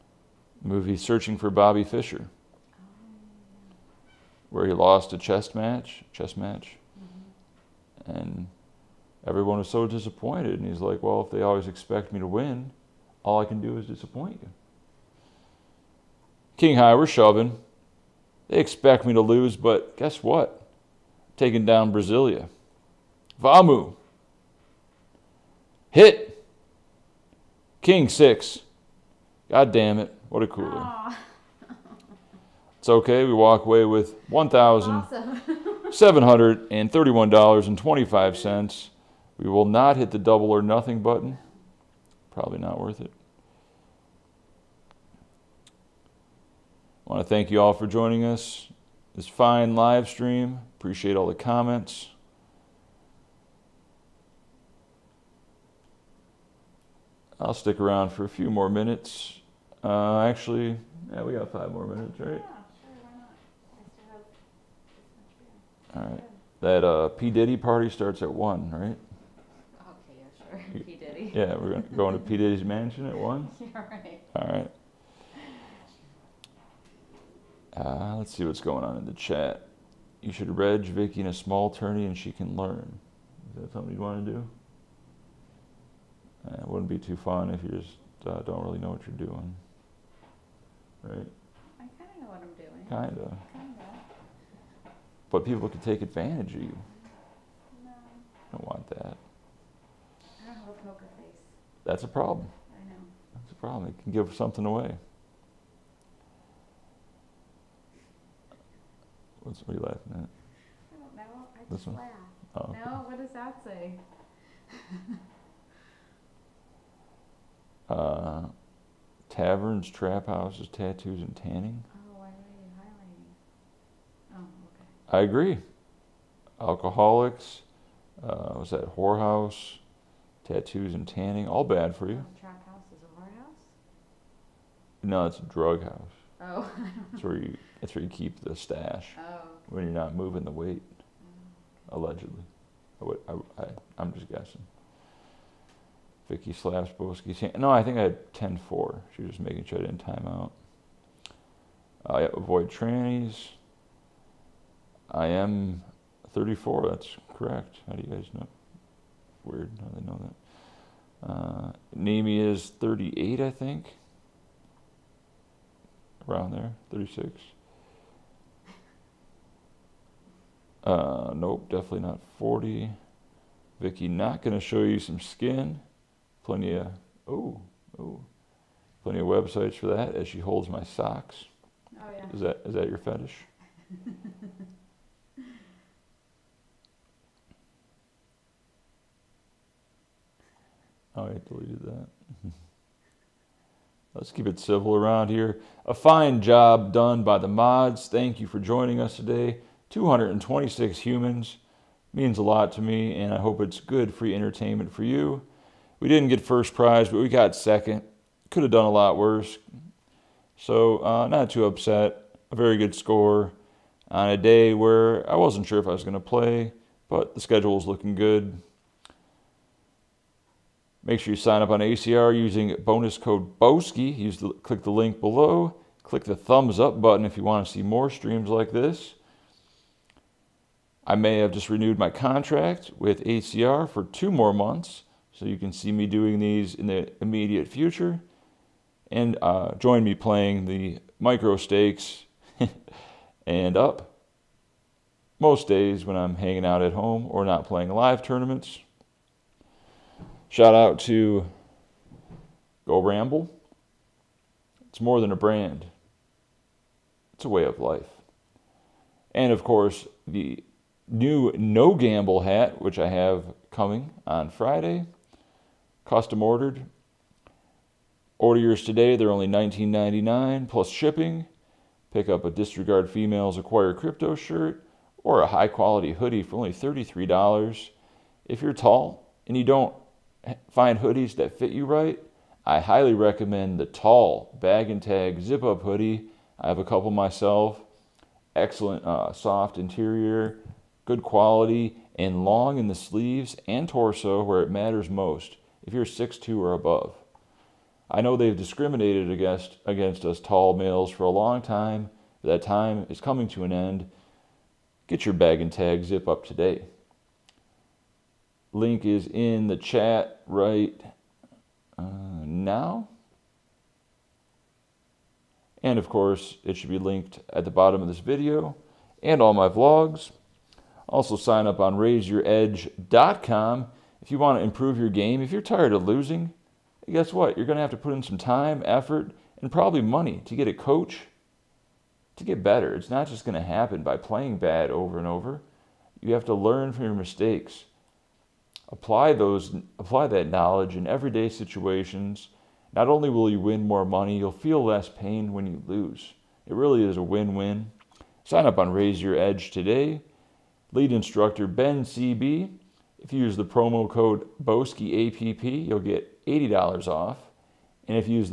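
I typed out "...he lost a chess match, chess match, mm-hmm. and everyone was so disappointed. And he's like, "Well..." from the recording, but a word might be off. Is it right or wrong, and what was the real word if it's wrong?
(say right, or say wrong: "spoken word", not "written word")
right.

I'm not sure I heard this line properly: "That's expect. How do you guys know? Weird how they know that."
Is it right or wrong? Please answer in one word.
wrong.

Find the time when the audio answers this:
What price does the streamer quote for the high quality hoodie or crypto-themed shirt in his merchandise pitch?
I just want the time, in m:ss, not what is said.
4:36.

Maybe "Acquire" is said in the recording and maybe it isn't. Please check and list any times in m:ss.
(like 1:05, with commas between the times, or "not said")
4:33.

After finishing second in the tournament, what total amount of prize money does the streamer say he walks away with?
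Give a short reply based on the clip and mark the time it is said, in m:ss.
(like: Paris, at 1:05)
$1,731.25, at 0:34.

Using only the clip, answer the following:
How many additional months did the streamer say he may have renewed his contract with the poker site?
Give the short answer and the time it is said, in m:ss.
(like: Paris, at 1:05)
2, at 3:54.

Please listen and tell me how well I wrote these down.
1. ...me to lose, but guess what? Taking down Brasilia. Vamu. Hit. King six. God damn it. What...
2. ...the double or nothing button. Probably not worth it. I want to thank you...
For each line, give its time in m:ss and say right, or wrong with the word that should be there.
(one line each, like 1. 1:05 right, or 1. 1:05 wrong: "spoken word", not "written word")
1. 0:19 right
2. 0:40 right.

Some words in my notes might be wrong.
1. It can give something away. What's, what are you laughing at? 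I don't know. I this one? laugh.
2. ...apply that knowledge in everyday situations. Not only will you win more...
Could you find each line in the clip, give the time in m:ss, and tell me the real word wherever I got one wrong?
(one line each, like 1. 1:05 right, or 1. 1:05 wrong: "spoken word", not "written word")
1. 1:43 right
2. 5:39 right.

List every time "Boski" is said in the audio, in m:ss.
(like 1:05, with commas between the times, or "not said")
2:26, 3:43.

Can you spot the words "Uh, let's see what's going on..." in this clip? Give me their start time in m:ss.
1:17.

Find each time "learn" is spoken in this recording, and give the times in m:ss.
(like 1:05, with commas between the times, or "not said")
1:22, 5:36.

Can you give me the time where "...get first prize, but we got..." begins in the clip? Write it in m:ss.
3:26.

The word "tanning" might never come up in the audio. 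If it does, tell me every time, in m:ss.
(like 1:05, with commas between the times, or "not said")
2:01, 2:11.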